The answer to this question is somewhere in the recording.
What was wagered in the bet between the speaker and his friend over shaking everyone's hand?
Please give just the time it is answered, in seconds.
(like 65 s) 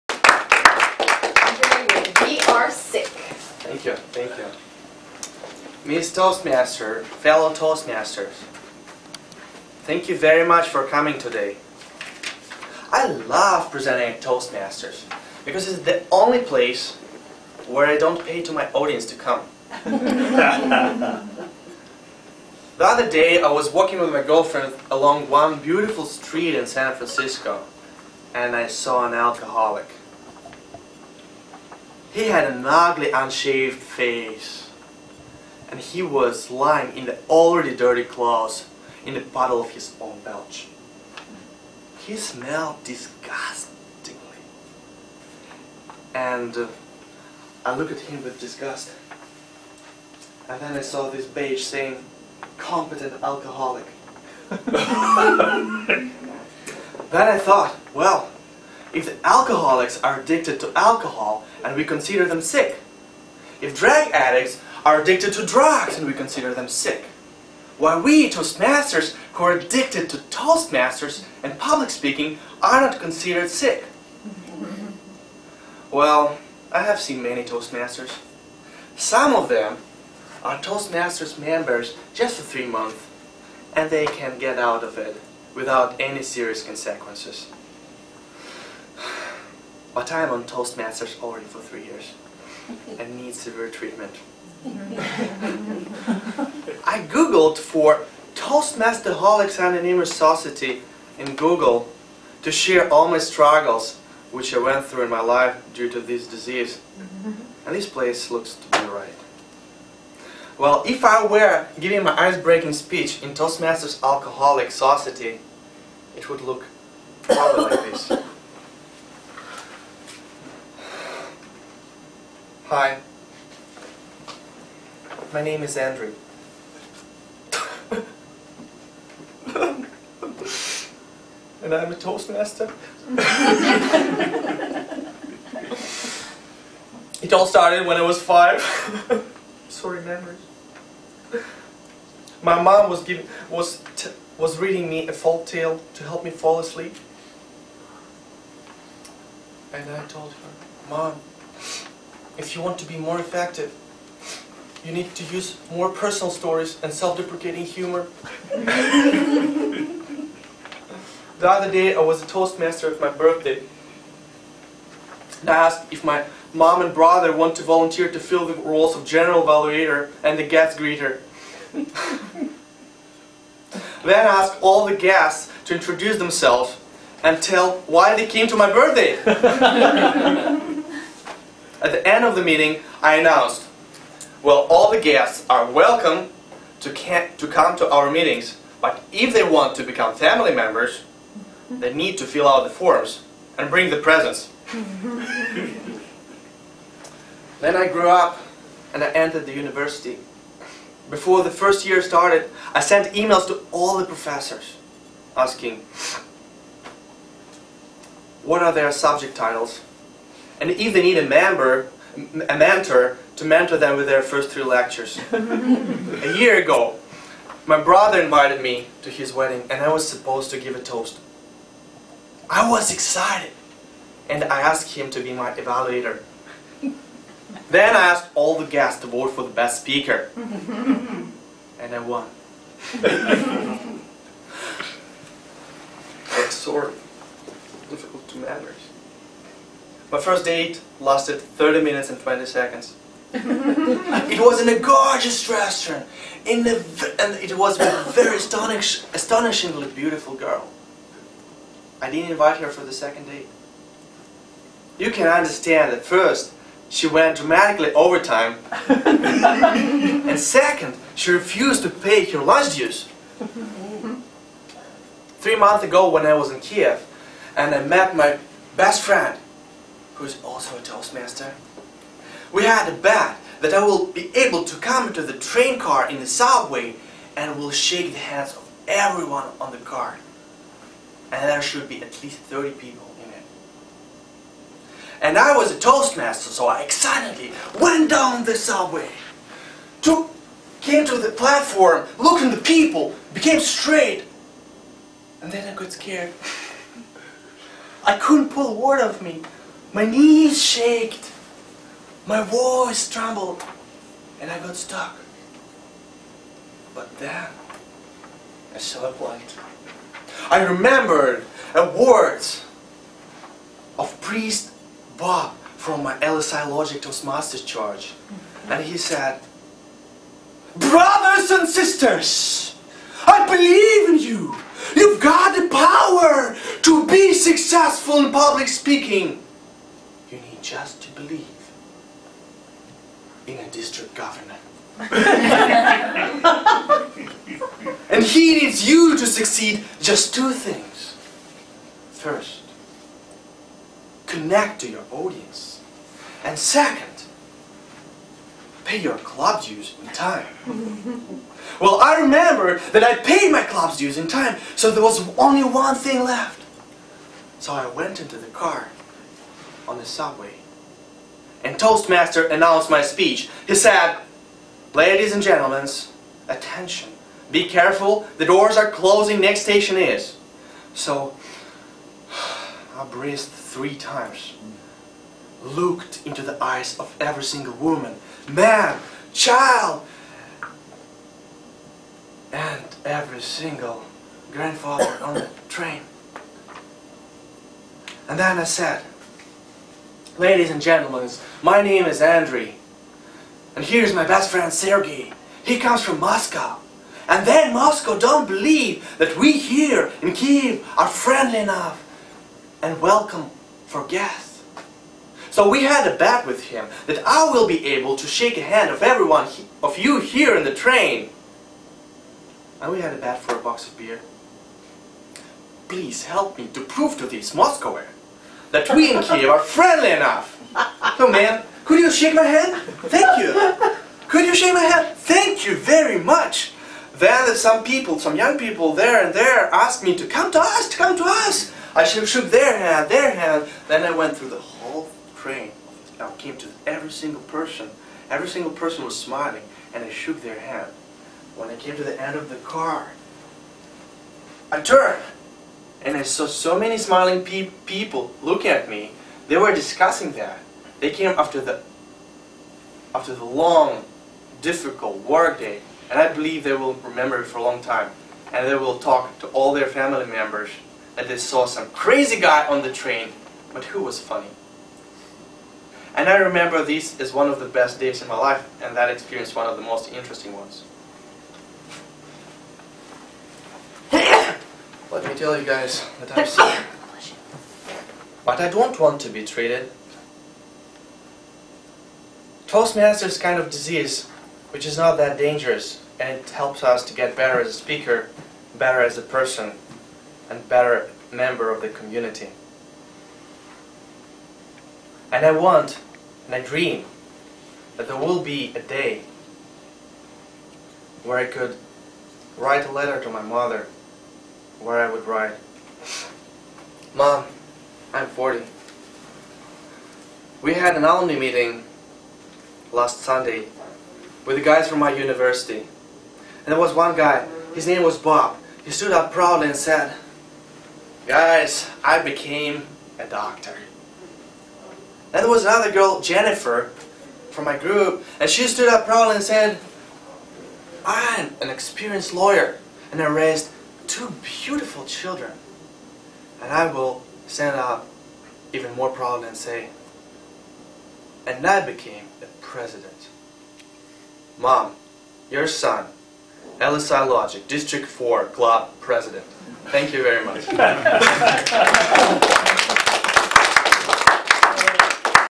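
413 s.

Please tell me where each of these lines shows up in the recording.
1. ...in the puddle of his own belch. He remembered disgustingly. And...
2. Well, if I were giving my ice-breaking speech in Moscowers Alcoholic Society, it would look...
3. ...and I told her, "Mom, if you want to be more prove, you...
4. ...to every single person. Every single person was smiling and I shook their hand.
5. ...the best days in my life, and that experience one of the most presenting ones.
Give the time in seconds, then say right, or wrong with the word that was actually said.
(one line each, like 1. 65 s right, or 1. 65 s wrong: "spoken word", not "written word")
1. 39 s wrong: "smelled", not "remembered"
2. 110 s wrong: "Toastmasters", not "Moscowers"
3. 149 s wrong: "effective", not "prove"
4. 436 s right
5. 467 s wrong: "interesting", not "presenting".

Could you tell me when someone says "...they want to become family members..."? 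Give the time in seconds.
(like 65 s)
189 s.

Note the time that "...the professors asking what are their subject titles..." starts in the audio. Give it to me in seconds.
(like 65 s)
203 s.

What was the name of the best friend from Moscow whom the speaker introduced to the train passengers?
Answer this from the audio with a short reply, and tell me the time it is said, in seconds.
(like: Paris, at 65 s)
Sergey, at 394 s.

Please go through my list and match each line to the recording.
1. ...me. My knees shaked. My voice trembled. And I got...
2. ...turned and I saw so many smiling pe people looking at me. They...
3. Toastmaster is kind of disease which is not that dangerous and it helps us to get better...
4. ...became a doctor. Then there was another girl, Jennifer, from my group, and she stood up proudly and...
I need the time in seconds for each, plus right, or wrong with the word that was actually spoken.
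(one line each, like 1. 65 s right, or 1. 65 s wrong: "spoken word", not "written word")
1. 299 s right
2. 444 s right
3. 482 s right
4. 522 s right.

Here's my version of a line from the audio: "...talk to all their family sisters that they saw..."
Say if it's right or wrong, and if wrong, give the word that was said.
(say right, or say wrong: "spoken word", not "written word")
wrong: "members", not "sisters".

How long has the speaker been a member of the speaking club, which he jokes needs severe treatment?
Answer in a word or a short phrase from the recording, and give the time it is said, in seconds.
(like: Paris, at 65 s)
3 years, at 91 s.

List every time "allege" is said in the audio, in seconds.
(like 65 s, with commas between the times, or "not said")
not said.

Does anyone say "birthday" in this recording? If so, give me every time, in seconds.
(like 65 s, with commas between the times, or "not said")
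163 s, 178 s.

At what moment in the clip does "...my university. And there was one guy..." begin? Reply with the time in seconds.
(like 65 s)
514 s.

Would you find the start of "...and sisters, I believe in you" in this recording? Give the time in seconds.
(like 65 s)
321 s.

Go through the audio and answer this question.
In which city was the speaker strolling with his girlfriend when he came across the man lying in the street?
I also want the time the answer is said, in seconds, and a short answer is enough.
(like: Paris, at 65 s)
San Francisco, at 26 s.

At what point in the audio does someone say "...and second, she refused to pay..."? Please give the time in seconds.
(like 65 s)
258 s.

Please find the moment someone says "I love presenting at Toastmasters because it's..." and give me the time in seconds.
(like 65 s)
12 s.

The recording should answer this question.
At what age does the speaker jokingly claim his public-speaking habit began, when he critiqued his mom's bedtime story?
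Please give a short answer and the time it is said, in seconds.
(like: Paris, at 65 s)
5, at 138 s.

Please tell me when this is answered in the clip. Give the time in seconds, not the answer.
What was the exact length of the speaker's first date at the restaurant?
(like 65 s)
241 s.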